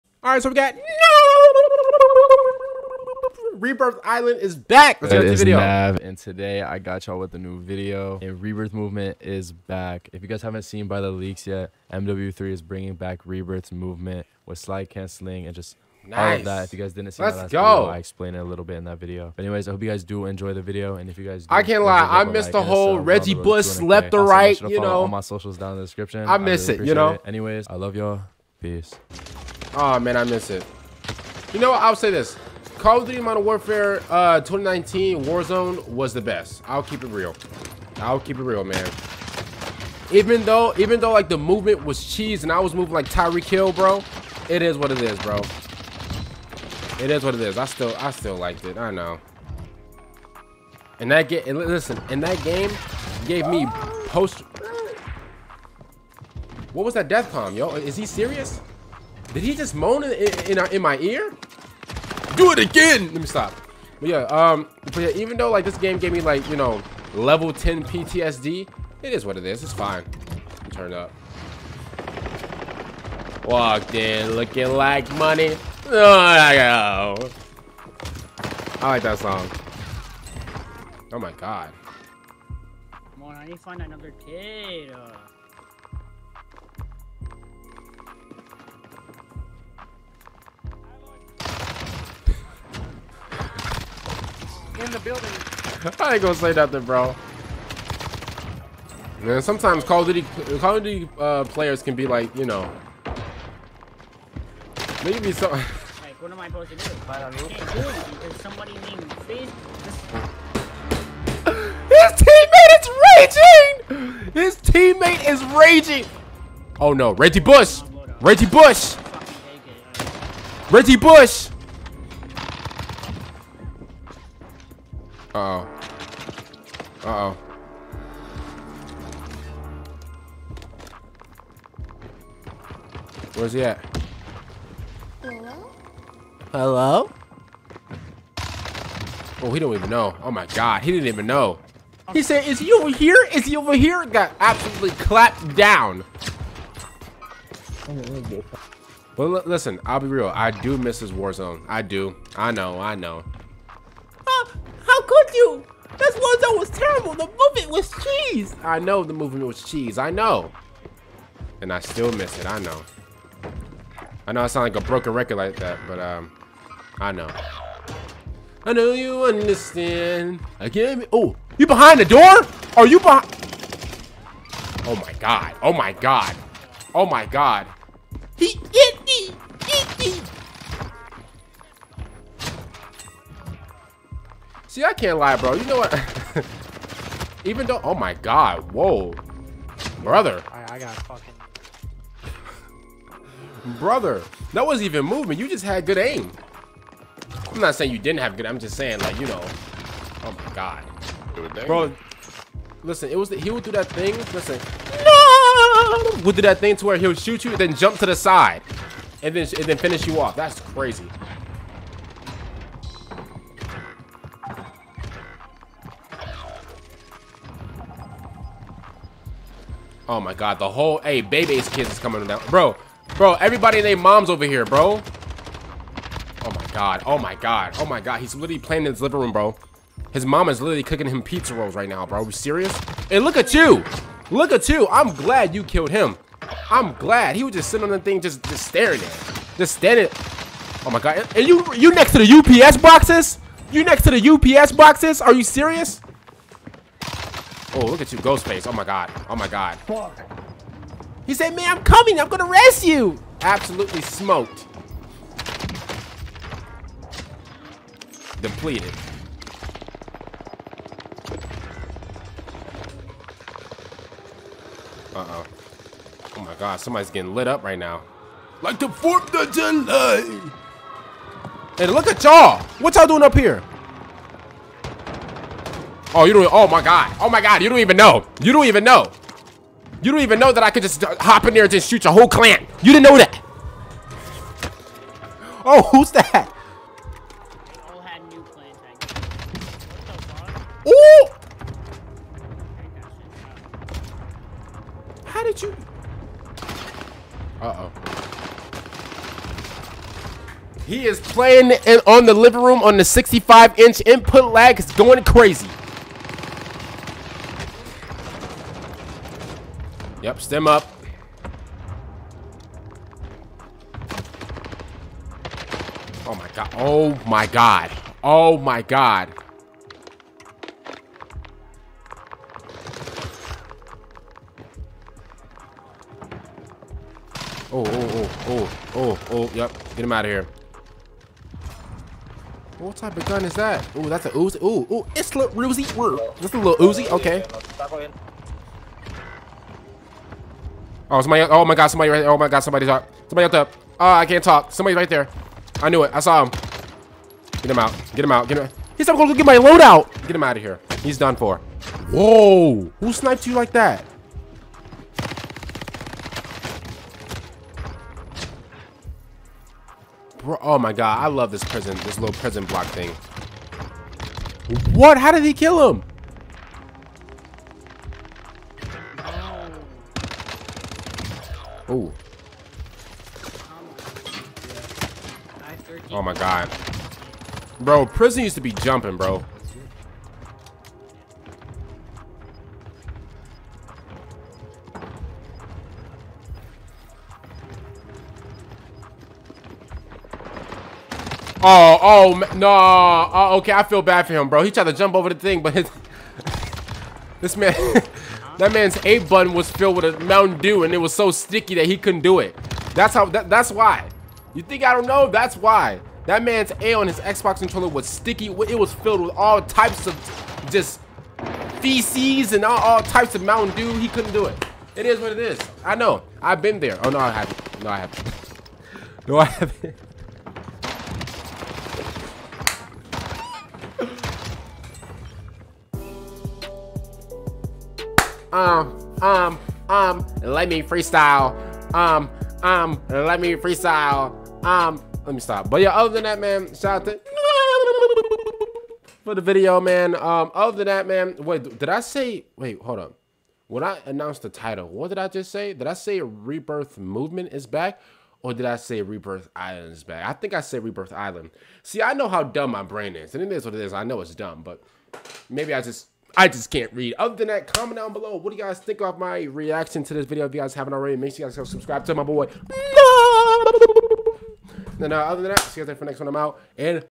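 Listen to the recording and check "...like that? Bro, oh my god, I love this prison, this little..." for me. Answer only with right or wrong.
right.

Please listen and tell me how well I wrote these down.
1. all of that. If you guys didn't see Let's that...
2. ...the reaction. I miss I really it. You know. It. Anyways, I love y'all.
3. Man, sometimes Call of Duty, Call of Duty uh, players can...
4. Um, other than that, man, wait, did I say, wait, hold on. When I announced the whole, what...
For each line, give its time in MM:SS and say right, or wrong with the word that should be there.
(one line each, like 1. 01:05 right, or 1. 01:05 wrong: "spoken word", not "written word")
1. 00:16 right
2. 00:25 wrong: "description", not "reaction"
3. 01:39 right
4. 07:20 wrong: "title", not "whole".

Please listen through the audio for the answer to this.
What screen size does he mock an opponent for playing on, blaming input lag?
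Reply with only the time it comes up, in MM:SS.
05:03.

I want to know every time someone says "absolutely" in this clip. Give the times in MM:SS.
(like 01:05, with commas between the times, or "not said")
02:24, 04:13.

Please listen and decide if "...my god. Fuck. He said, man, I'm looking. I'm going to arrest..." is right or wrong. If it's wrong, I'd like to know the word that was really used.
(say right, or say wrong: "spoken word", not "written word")
wrong: "coming", not "looking".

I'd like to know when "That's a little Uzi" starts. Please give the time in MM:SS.
05:36.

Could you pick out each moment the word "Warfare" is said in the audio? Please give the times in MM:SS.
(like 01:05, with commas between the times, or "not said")
00:33.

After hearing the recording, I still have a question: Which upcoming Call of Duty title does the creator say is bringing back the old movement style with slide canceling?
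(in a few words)
MW3.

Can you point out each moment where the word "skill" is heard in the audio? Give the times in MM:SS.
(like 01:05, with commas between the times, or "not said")
not said.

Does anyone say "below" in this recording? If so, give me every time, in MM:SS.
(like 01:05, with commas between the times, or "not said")
07:38.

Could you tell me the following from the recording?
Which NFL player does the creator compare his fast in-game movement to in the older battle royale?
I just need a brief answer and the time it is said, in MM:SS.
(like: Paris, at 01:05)
Tyreek Hill, at 00:43.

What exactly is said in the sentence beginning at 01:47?
I can't do somebody named His teammate is raging.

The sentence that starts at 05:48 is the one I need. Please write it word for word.
He's not gonna go get my loadout.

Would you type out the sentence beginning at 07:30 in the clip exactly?
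I think I said Rebirth Island.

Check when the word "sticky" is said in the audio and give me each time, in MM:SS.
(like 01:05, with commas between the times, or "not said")
06:41, 06:48.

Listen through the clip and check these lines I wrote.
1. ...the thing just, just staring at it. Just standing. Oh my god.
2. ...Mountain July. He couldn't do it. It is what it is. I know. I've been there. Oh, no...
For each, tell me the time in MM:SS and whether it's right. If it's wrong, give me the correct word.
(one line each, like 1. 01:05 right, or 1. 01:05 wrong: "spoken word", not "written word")
1. 03:57 right
2. 06:53 wrong: "Dew", not "July".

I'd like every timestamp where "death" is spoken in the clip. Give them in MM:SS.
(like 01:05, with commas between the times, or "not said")
00:57.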